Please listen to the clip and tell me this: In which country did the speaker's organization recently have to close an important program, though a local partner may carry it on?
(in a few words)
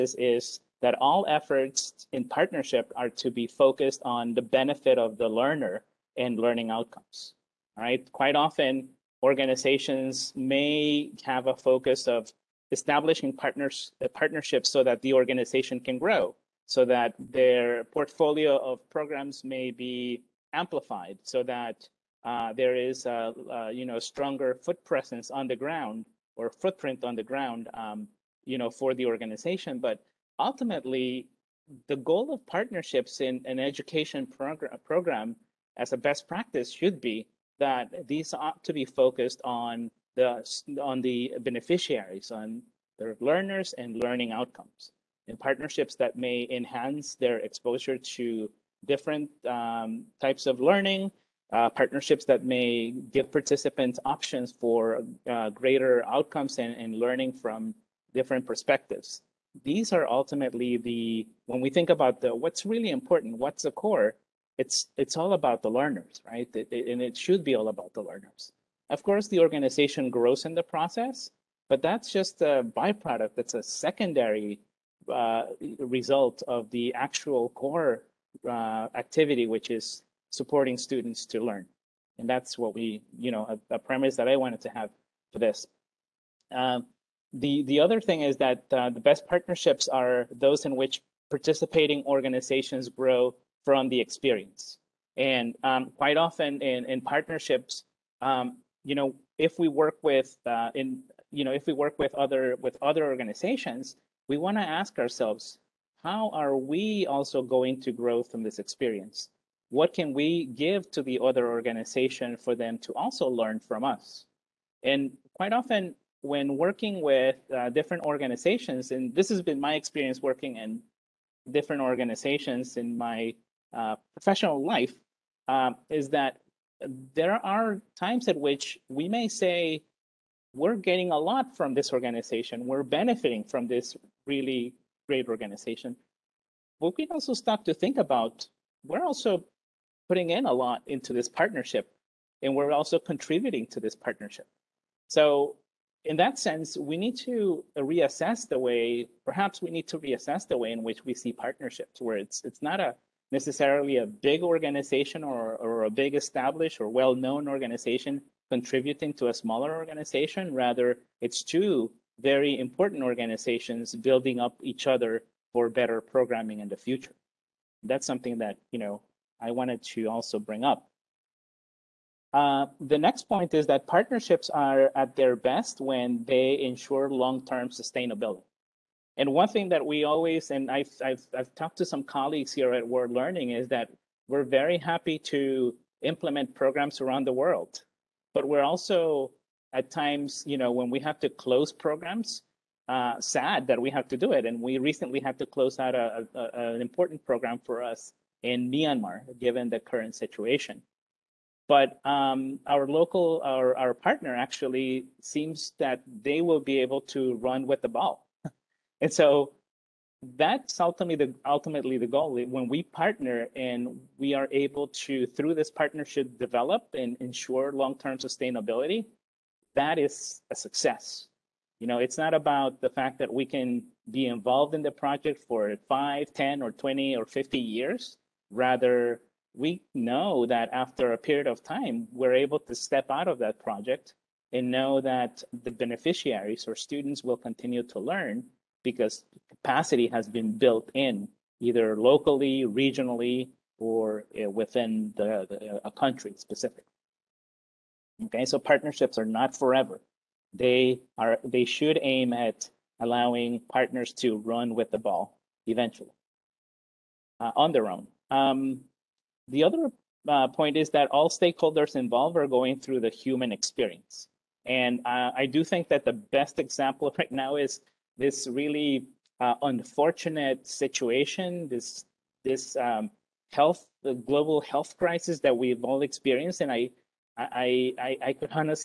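Myanmar.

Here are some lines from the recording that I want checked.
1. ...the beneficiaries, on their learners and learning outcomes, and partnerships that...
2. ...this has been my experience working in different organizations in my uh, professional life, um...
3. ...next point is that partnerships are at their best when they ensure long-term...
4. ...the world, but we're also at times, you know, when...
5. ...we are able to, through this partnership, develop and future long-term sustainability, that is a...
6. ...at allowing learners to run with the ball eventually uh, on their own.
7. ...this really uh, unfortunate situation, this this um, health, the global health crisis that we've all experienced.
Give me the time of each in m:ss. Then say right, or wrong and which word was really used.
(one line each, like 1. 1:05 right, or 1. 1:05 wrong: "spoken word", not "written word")
1. 0:41 right
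2. 1:59 right
3. 2:52 right
4. 3:07 right
5. 3:34 wrong: "ensure", not "future"
6. 4:12 wrong: "partners", not "learners"
7. 4:28 right.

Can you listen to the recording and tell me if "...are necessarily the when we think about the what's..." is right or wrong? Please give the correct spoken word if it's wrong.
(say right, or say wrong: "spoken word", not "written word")
wrong: "ultimately", not "necessarily".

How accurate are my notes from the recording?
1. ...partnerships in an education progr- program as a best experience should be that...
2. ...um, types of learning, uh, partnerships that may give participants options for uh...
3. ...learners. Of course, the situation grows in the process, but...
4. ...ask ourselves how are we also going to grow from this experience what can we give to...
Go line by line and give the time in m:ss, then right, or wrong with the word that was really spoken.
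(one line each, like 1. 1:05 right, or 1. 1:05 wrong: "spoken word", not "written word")
1. 0:32 wrong: "practice", not "experience"
2. 0:49 right
3. 1:08 wrong: "organization", not "situation"
4. 1:44 right.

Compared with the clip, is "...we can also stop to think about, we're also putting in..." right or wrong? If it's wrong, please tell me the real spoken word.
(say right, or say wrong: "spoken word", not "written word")
right.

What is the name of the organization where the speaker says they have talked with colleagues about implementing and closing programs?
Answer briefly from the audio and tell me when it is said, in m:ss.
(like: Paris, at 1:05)
World Learning, at 3:02.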